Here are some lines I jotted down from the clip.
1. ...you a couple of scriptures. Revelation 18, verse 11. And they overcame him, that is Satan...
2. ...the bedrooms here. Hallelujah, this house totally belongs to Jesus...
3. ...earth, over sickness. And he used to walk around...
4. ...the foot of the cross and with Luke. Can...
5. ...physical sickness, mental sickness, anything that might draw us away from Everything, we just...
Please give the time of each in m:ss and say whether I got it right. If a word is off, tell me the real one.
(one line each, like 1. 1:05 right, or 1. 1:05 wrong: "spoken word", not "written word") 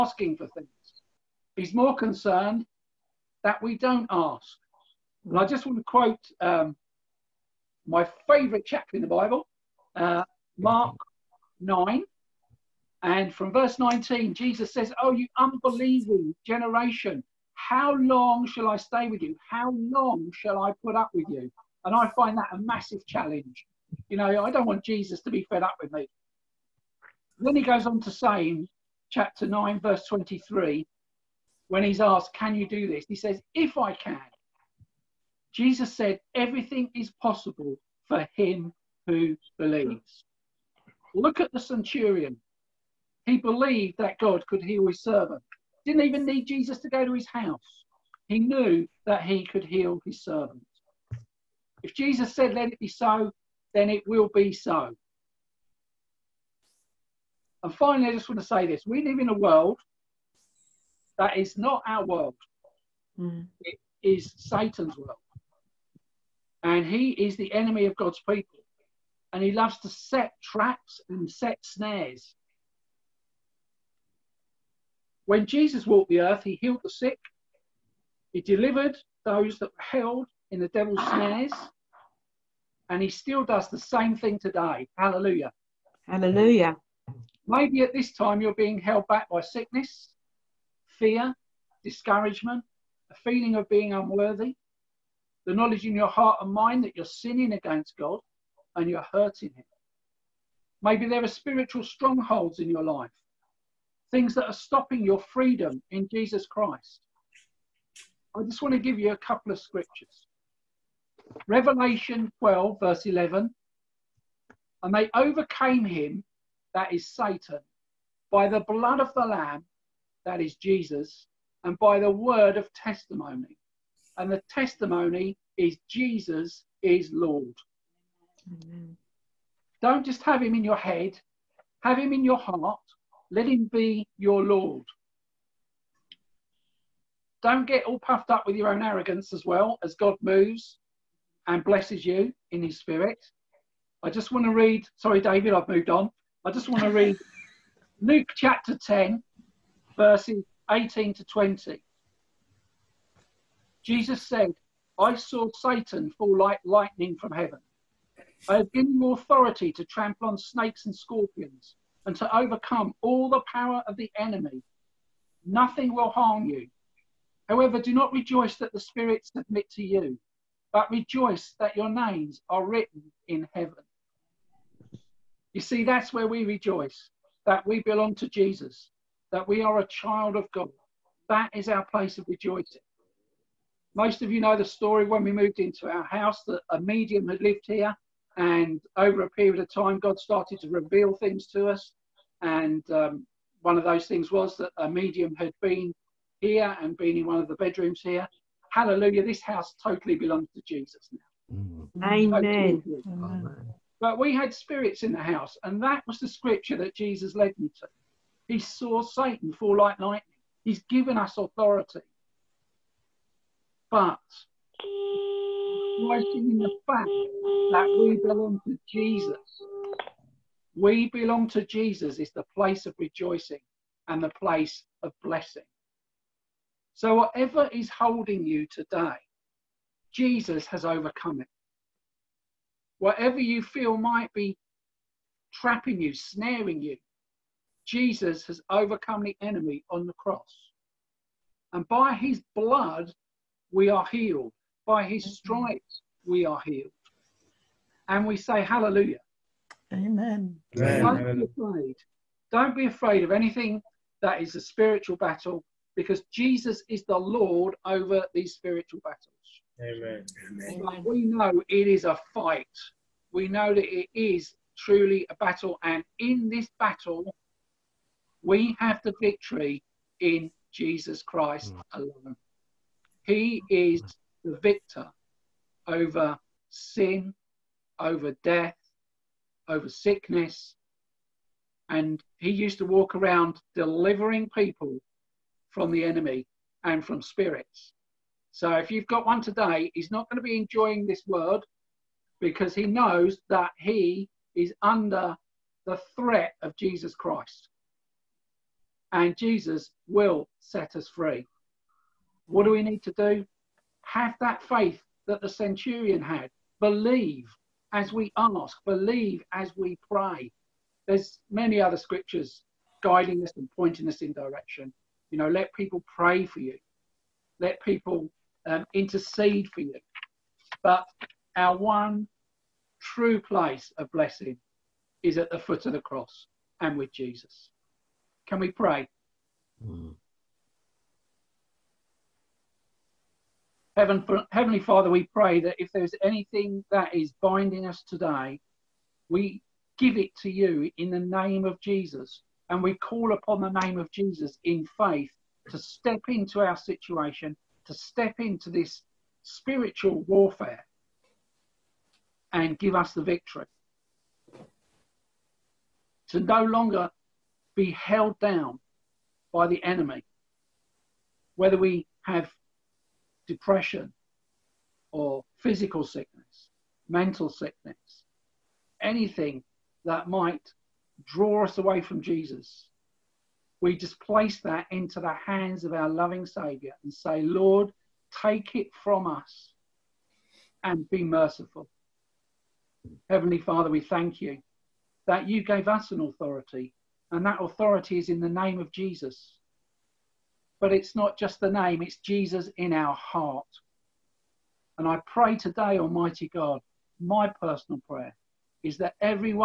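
1. 1:48 wrong: "12", not "18"
2. 3:17 right
3. 4:38 wrong: "death", not "earth"
4. 5:25 wrong: "Jesus", not "Luke"
5. 6:05 wrong: "Jesus", not "Everything".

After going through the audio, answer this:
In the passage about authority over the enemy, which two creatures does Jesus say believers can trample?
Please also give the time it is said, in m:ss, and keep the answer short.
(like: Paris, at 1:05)
Snakes and scorpions, at 2:40.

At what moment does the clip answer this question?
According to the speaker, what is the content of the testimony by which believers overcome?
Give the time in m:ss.
2:05.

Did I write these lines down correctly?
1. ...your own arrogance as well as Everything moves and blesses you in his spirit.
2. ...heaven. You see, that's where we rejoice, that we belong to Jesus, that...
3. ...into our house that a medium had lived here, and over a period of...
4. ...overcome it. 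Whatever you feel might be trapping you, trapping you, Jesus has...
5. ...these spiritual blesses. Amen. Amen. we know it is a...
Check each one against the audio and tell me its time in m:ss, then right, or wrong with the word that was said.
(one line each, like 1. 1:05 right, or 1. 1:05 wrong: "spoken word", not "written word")
1. 2:18 wrong: "God", not "Everything"
2. 2:53 right
3. 3:05 right
4. 3:50 wrong: "snaring", not "trapping"
5. 4:18 wrong: "battles", not "blesses".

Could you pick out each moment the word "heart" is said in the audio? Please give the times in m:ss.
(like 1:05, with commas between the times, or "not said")
1:36, 2:12, 6:33.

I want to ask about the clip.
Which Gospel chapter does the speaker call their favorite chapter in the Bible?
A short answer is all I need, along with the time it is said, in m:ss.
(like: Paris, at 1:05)
Mark 9, at 0:10.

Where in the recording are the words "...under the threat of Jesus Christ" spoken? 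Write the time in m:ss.
4:54.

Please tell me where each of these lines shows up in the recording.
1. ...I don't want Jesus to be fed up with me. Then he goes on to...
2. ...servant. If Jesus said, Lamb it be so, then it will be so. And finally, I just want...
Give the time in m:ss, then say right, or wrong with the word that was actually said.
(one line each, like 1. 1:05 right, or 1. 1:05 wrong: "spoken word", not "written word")
1. 0:24 right
2. 0:50 wrong: "Let", not "Lamb".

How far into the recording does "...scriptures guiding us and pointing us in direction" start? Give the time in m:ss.
5:11.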